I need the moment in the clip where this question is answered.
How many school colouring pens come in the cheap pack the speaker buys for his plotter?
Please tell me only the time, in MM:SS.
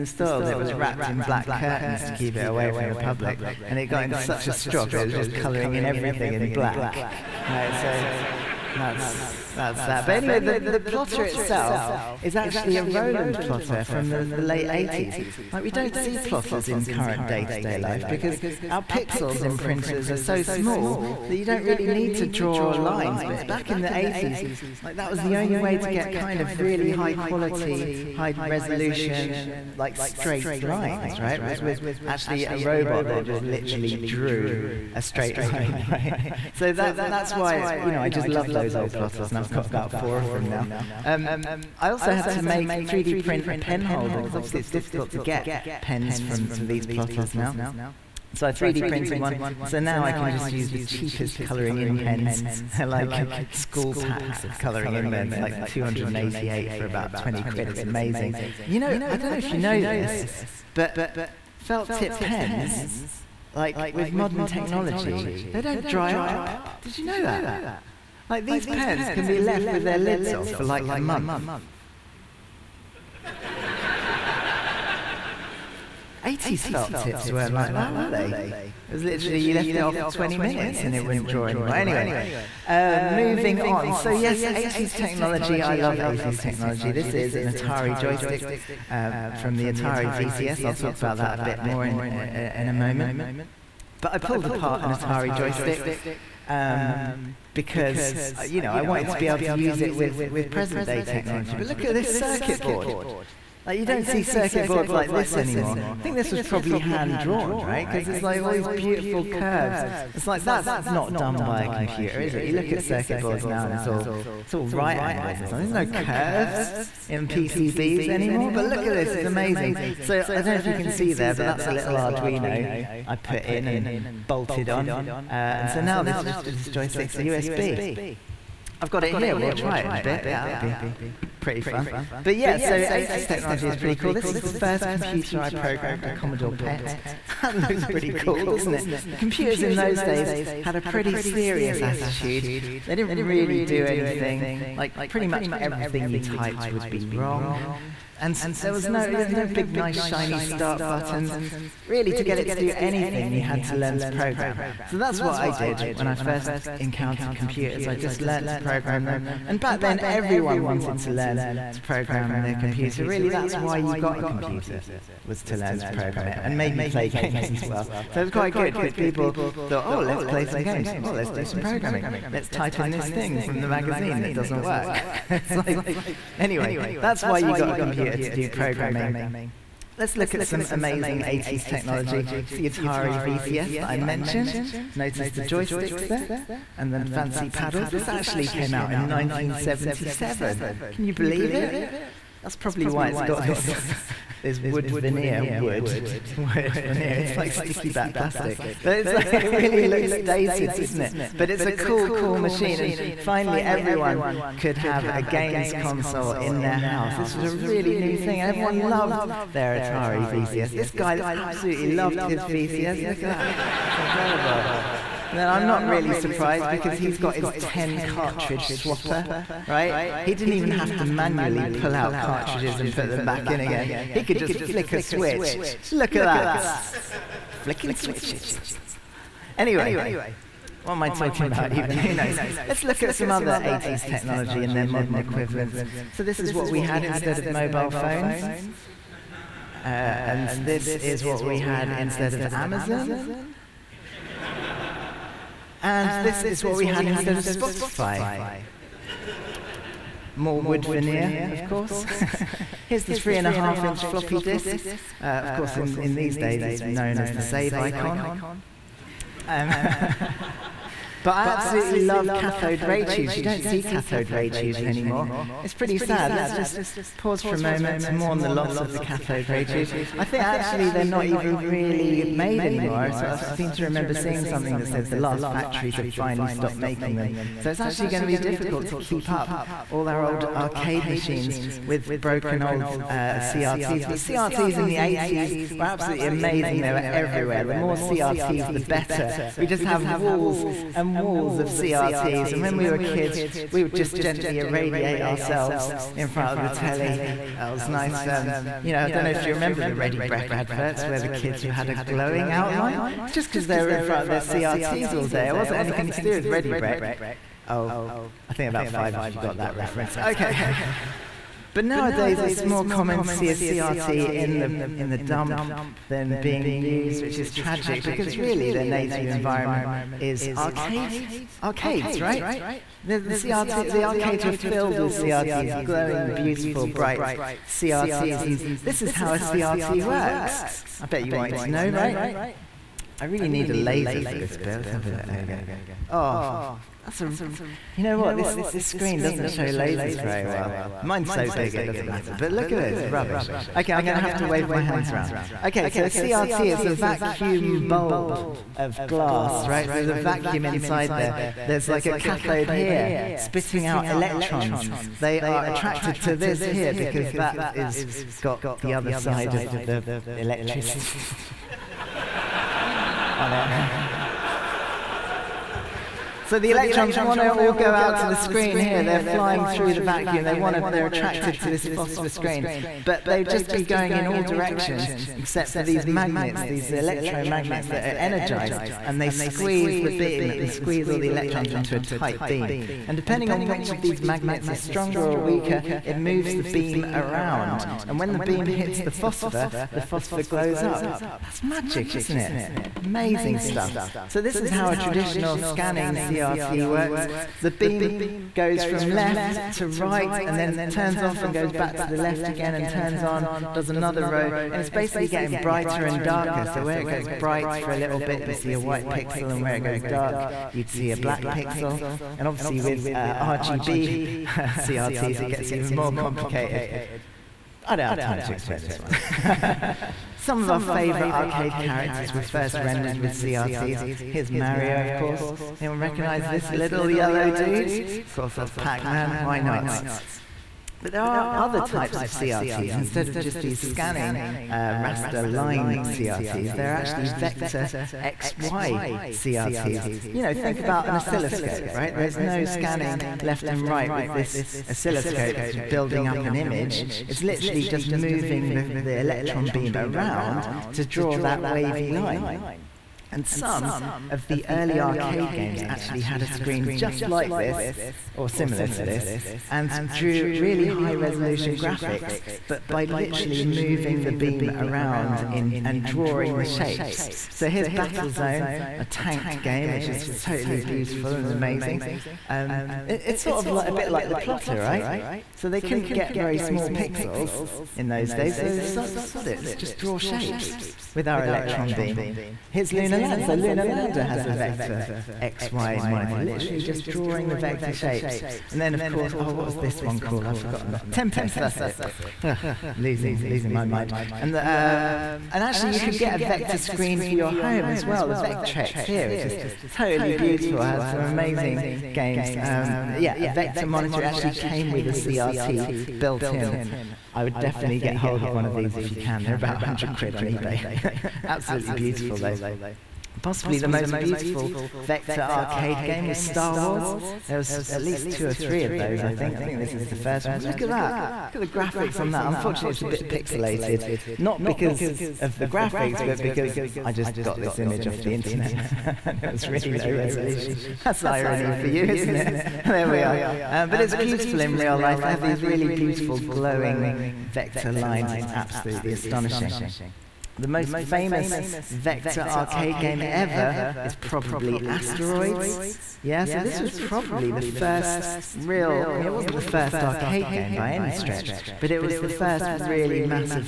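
00:55.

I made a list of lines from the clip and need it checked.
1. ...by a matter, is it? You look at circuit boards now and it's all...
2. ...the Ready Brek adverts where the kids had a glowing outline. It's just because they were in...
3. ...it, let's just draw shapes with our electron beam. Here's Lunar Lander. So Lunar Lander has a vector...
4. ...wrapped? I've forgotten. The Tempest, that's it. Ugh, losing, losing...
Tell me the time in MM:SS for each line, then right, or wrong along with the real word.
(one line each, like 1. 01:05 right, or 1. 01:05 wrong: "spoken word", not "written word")
1. 01:51 wrong: "computer", not "matter"
2. 04:59 right
3. 07:59 right
4. 08:10 wrong: "called", not "wrapped".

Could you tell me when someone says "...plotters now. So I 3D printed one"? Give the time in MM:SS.
00:46.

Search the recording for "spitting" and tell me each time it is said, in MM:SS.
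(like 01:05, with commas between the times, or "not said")
05:53.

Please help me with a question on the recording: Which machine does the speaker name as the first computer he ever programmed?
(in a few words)
Commodore PET.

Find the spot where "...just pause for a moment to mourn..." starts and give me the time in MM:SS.
04:26.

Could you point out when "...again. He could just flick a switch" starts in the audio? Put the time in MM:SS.
03:43.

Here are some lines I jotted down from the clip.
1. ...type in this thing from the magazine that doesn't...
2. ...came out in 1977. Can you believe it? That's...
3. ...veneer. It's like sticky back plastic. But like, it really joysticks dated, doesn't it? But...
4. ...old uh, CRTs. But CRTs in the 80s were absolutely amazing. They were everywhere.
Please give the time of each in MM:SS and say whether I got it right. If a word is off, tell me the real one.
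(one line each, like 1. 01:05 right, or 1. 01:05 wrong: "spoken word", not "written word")
1. 02:52 right
2. 03:08 right
3. 03:16 wrong: "looks", not "joysticks"
4. 04:42 right.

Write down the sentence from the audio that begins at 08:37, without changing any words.
There was at least two or three of those, I think.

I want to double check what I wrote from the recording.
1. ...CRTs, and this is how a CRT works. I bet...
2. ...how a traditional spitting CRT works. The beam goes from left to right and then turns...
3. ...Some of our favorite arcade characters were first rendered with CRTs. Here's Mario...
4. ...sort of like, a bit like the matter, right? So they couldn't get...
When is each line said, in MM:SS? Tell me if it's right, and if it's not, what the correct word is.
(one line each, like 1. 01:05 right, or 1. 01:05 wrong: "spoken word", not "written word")
1. 05:27 right
2. 06:34 wrong: "scanning", not "spitting"
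3. 07:00 right
4. 07:53 wrong: "plotter", not "matter".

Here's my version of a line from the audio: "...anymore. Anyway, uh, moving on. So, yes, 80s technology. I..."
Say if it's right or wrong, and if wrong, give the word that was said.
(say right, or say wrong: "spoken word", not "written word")
right.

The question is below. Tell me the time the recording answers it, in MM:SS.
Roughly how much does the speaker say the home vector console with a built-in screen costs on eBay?
08:29.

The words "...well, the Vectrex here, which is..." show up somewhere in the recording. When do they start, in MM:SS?
08:18.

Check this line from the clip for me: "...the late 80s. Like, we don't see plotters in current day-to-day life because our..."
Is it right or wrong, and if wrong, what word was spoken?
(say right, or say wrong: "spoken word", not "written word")
right.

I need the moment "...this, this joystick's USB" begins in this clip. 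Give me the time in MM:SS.
02:06.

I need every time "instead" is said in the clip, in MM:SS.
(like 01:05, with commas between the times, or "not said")
03:57, 04:01, 04:07, 07:12.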